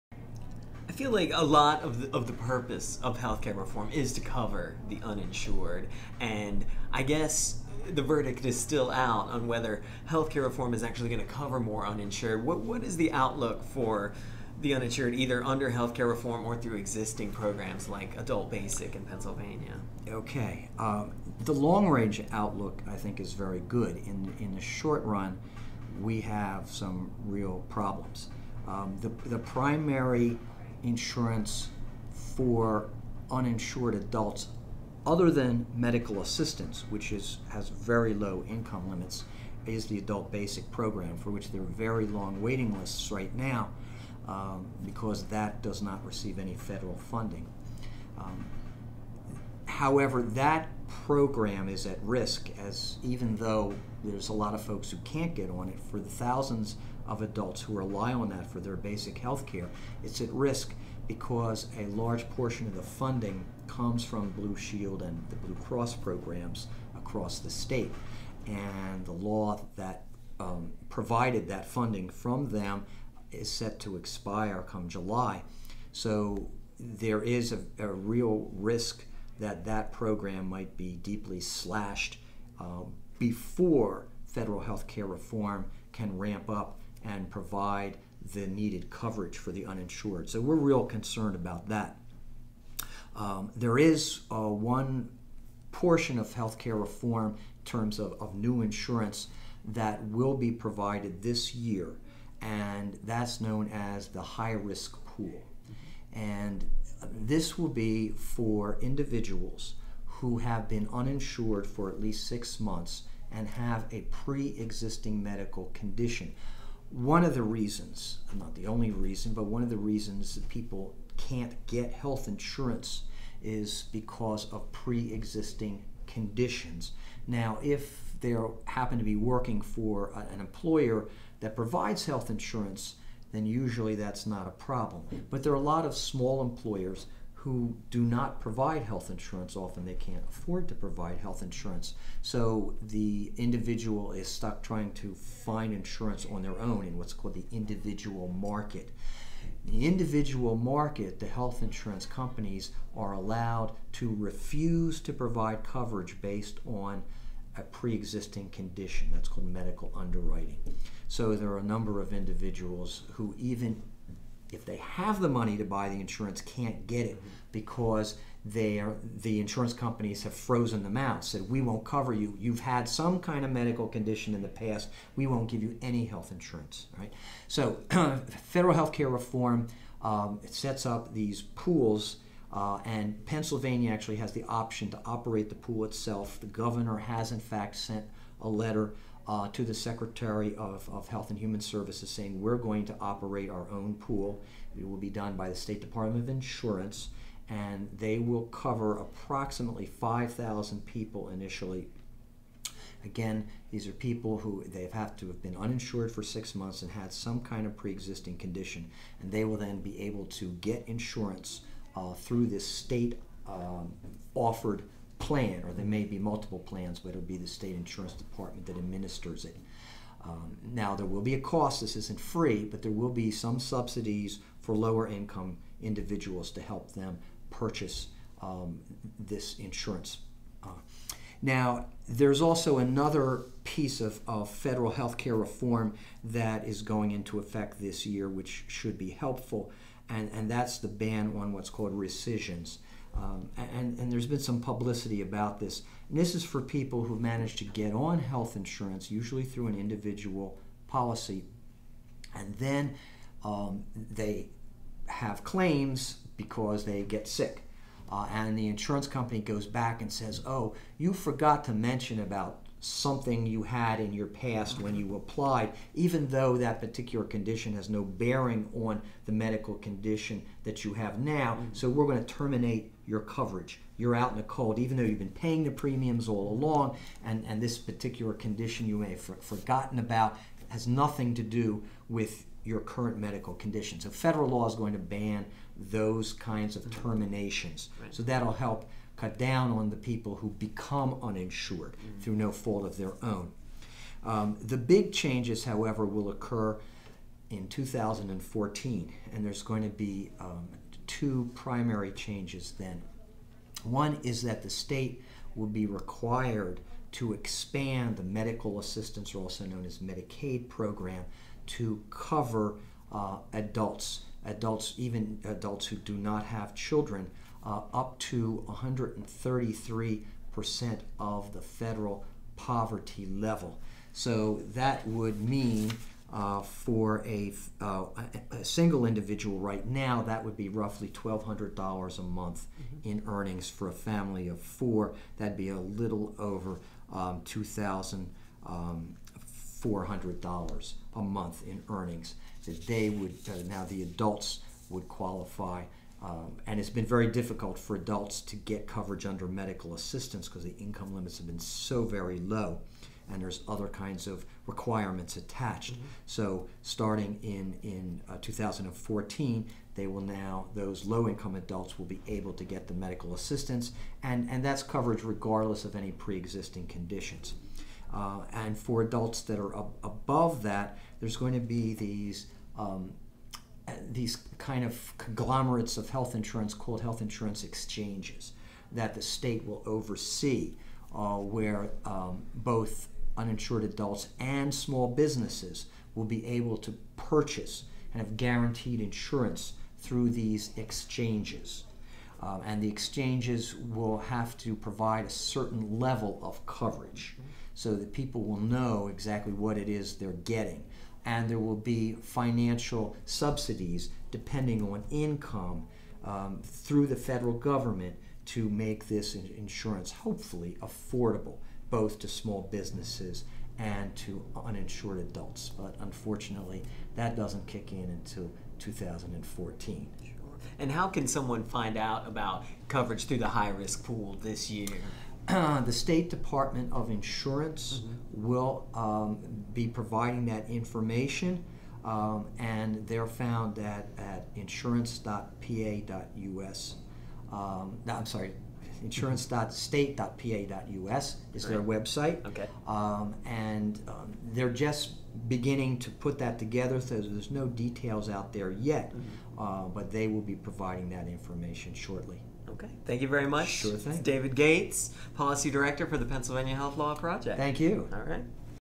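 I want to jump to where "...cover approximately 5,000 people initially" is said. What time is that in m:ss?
3:18.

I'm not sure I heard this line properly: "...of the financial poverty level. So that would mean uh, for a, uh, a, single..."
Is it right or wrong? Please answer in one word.
wrong.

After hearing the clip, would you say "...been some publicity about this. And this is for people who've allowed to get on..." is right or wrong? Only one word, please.
wrong.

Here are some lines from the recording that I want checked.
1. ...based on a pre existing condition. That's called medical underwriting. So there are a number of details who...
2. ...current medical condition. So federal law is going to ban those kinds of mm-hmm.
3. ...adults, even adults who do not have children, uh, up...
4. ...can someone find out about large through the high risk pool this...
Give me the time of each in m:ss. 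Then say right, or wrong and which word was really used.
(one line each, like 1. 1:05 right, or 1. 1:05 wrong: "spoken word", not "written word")
1. 2:36 wrong: "individuals", not "details"
2. 4:42 right
3. 5:14 right
4. 7:01 wrong: "coverage", not "large".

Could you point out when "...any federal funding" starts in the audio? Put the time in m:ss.
0:46.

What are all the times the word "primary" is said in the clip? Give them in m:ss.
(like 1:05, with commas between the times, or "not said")
0:29, 5:01.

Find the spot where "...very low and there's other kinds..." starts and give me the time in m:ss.
5:52.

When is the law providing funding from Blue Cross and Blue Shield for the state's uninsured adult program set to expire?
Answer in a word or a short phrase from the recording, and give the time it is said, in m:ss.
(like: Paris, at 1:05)
July, at 1:14.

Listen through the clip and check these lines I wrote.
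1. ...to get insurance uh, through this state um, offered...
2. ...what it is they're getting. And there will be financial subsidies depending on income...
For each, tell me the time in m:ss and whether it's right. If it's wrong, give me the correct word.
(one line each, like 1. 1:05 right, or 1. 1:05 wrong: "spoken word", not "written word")
1. 3:30 right
2. 6:39 right.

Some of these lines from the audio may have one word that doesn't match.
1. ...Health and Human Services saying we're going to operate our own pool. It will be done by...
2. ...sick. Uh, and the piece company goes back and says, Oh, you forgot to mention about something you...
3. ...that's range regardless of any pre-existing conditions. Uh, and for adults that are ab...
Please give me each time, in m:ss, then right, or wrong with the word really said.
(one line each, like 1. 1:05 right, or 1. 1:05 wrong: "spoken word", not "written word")
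1. 3:11 right
2. 4:17 wrong: "insurance", not "piece"
3. 6:04 wrong: "coverage", not "range".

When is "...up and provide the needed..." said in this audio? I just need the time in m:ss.
1:26.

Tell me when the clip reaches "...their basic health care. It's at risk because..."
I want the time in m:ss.
0:58.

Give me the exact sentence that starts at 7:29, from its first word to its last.
uh, but they will be providing that information shortly.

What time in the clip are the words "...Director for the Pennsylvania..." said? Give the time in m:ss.
7:35.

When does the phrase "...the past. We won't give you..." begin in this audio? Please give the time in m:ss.
2:54.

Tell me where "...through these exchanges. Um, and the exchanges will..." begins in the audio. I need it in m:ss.
6:29.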